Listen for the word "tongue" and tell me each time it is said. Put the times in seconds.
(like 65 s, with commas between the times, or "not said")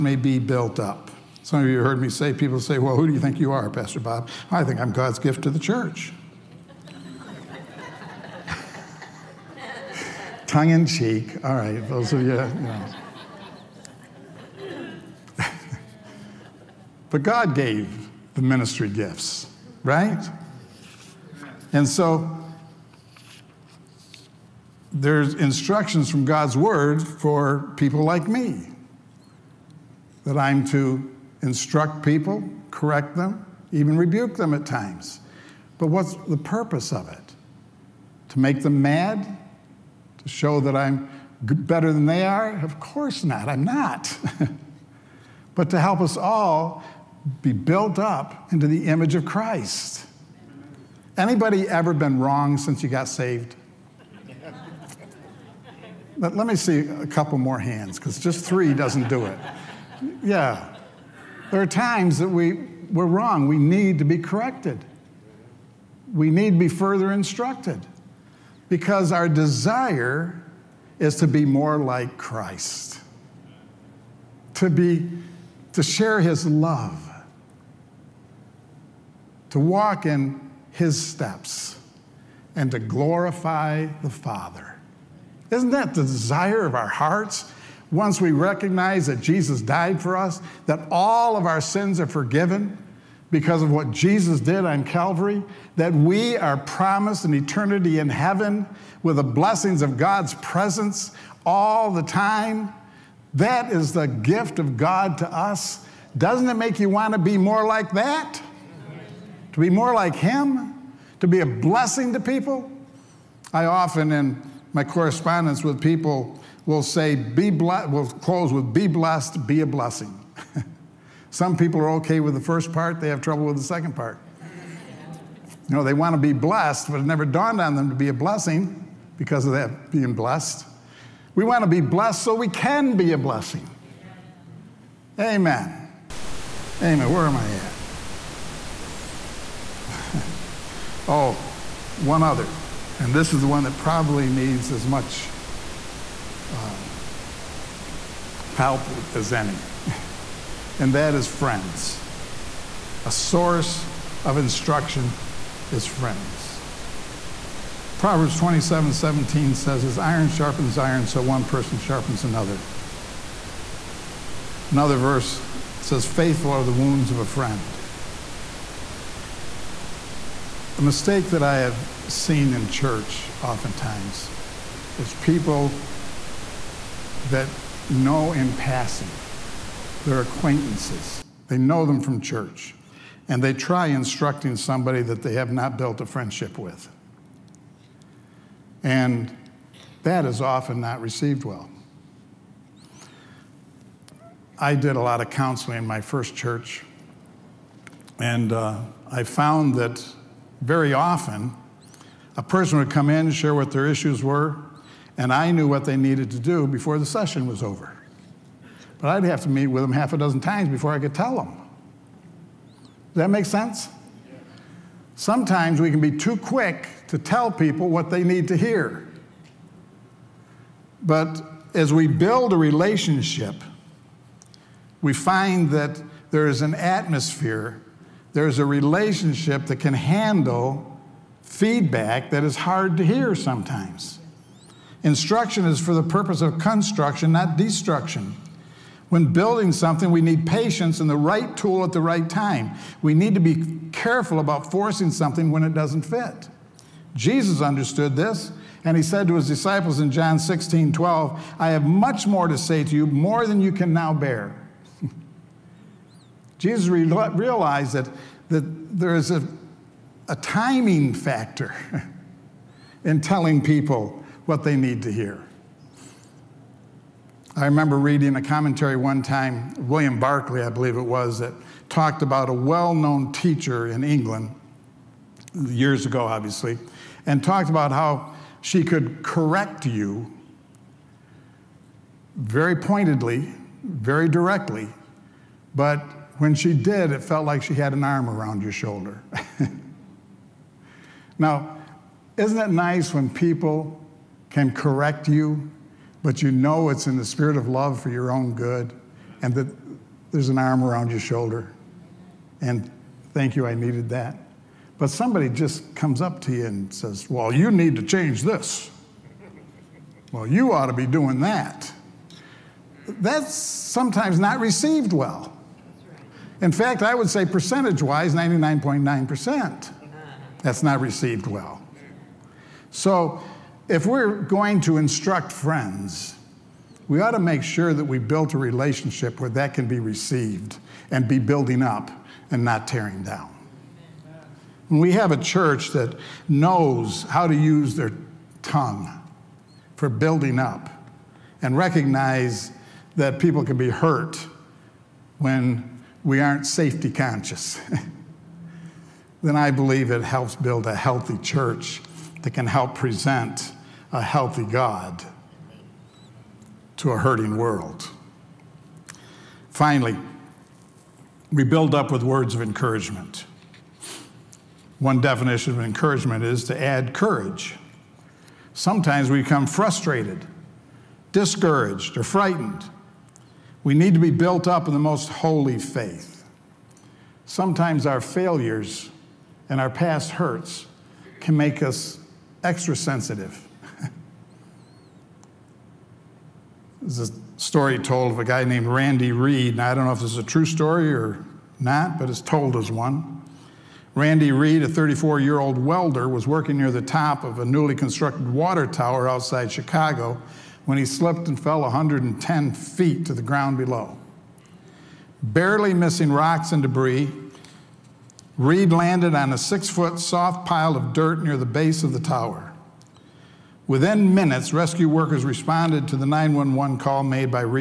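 10 s, 338 s.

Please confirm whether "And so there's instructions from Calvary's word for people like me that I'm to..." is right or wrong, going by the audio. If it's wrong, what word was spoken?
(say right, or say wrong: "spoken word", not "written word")
wrong: "God", not "Calvary".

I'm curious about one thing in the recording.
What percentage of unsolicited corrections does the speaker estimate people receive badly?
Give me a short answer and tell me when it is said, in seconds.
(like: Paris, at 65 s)
99.9%, at 318 s.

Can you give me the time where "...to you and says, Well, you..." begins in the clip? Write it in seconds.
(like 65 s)
306 s.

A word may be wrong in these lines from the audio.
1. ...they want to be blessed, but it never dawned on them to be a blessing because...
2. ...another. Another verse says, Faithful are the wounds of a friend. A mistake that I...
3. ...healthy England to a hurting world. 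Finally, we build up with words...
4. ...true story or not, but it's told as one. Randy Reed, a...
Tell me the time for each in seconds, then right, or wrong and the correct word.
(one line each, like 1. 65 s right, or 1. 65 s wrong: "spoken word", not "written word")
1. 125 s right
2. 162 s right
3. 354 s wrong: "God", not "England"
4. 390 s right.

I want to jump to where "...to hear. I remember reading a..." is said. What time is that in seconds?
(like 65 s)
265 s.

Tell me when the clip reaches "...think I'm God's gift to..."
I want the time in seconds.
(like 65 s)
4 s.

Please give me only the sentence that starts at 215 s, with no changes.
Sometimes we can be too quick to tell people what they need to hear.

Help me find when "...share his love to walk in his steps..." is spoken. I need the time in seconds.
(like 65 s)
75 s.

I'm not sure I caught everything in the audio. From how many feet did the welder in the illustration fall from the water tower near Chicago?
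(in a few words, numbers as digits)
110 feet.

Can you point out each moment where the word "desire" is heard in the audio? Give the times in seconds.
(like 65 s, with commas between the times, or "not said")
69 s, 86 s.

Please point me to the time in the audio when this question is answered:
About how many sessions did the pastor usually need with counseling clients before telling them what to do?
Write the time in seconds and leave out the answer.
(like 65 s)
209 s.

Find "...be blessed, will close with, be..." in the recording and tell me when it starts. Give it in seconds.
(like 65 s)
117 s.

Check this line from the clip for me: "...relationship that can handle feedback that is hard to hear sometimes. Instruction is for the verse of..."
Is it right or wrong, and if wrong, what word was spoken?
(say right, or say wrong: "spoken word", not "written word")
wrong: "purpose", not "verse".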